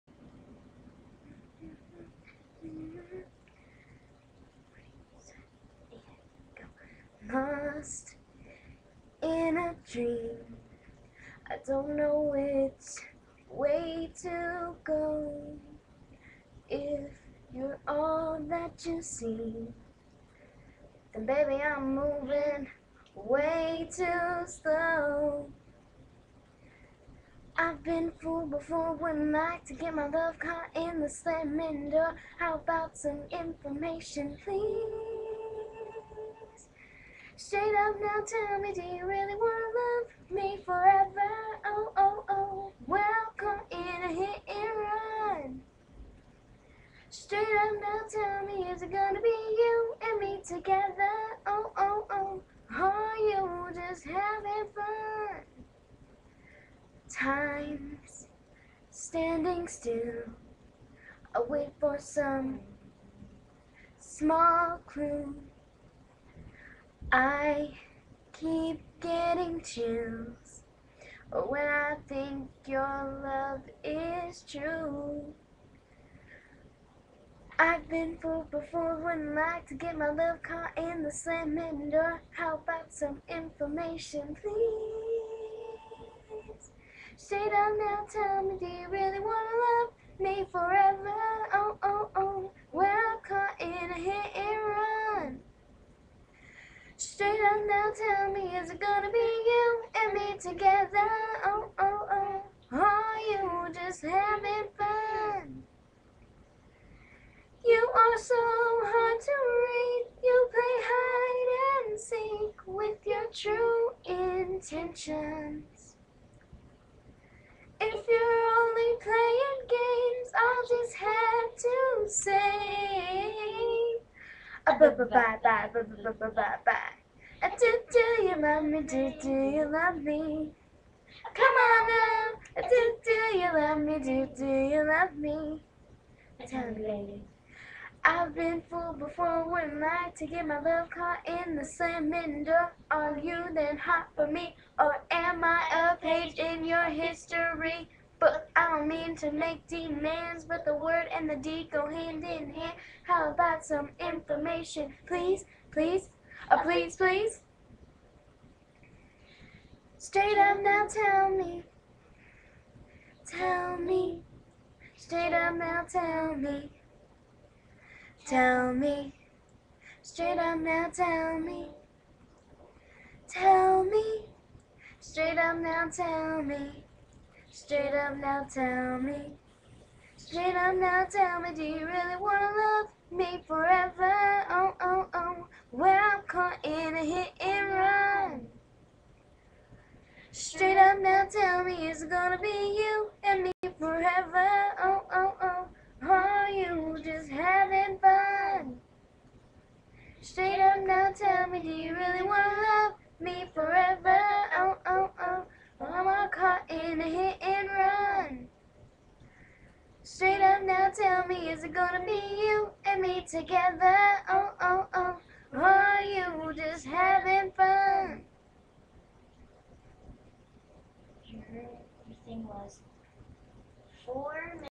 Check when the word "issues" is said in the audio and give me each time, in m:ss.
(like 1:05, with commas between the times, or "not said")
not said.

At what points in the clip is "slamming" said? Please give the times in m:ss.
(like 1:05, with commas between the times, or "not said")
0:31, 1:21.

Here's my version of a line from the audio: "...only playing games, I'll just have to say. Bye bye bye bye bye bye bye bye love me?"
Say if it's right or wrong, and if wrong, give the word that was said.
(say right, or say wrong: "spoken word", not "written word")
right.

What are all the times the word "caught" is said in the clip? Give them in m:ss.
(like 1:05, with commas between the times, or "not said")
0:30, 1:20, 2:20, 3:26.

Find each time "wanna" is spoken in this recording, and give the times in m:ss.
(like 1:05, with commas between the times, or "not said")
0:39, 1:29, 3:02, 3:22.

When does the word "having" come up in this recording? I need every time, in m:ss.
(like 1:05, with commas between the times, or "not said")
0:54, 1:44, 3:17, 3:36.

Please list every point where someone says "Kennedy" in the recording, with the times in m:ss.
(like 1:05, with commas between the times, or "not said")
not said.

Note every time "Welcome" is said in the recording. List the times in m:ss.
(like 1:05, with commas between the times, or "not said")
0:42.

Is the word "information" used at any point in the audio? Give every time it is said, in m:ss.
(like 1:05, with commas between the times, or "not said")
0:33, 1:23, 2:34.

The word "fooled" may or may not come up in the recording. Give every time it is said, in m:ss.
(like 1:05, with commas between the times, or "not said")
0:28, 1:18, 2:18.